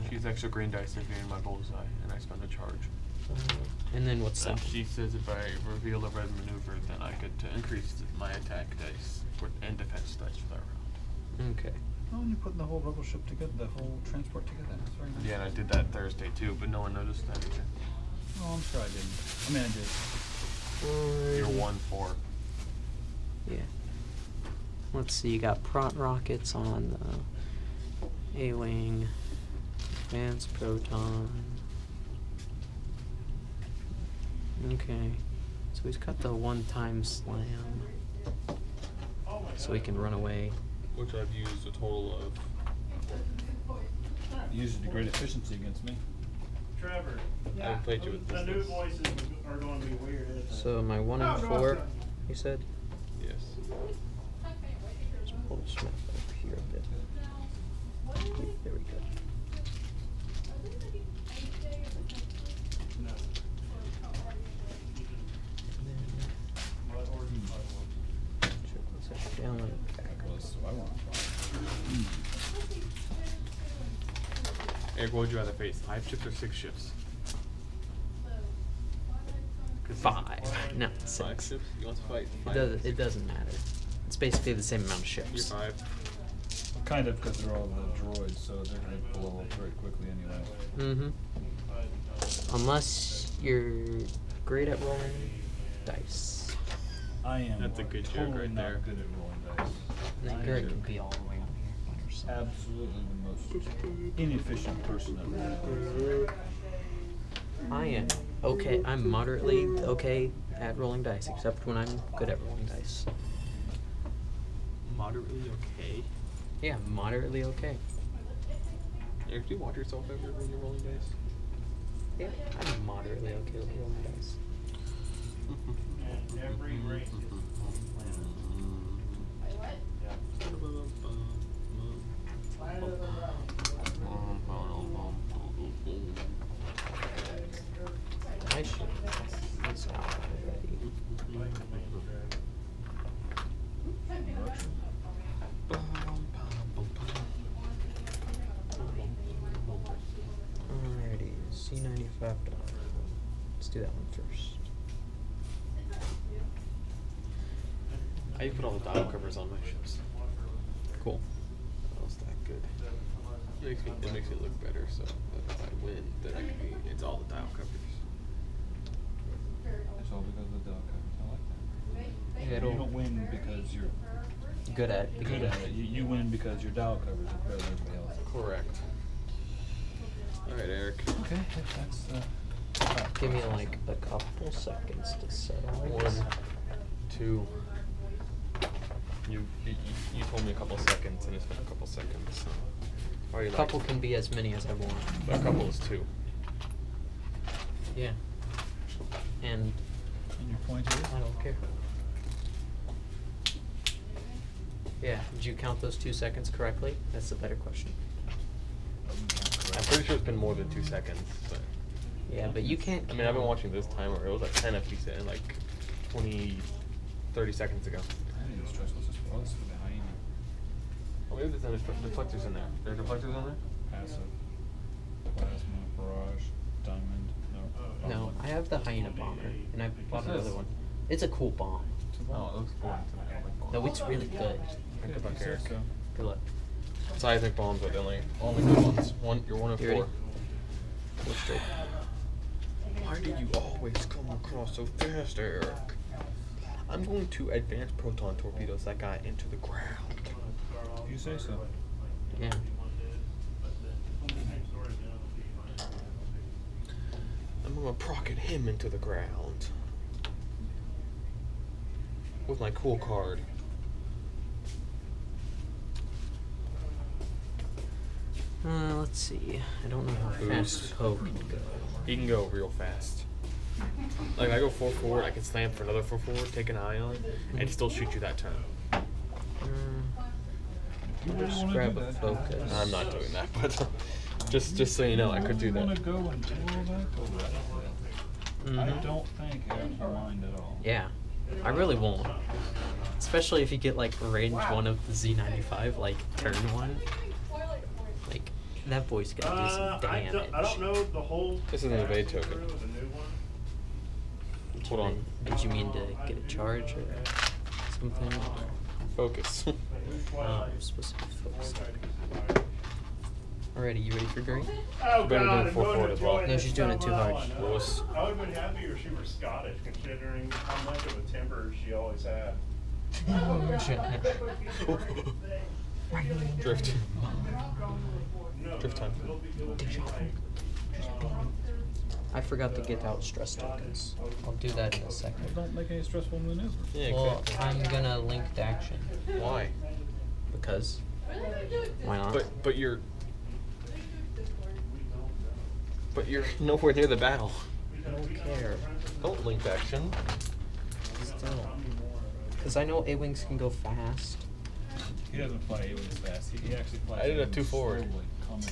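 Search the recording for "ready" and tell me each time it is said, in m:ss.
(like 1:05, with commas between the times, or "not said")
3:59, 5:14.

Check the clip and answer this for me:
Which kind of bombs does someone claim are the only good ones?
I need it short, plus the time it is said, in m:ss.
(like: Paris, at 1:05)
Seismic bombs, at 3:57.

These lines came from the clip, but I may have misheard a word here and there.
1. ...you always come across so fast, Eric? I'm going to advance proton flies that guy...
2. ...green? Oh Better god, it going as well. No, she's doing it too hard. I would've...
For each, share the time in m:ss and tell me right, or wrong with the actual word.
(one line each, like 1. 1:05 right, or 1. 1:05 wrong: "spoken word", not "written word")
1. 4:03 wrong: "torpedoes", not "flies"
2. 5:14 right.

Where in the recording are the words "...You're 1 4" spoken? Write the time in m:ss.
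0:21.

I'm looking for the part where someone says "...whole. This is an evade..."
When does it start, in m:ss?
5:01.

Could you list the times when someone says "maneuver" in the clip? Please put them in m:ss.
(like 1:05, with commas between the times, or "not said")
0:06, 5:36.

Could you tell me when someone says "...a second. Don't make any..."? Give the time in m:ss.
5:35.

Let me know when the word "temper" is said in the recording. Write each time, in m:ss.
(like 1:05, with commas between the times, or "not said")
5:21.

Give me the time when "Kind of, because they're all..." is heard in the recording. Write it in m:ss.
1:26.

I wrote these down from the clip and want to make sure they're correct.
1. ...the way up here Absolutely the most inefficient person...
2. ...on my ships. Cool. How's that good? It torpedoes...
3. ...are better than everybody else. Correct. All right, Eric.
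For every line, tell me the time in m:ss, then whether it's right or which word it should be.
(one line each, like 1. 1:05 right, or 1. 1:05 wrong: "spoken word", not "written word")
1. 1:41 right
2. 2:39 wrong: "makes", not "torpedoes"
3. 2:57 right.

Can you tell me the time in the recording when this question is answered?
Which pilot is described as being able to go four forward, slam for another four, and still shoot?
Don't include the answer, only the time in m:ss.
4:30.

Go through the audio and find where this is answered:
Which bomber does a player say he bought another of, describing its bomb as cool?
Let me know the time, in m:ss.
3:48.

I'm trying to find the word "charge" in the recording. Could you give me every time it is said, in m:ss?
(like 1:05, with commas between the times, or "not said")
0:02, 5:06.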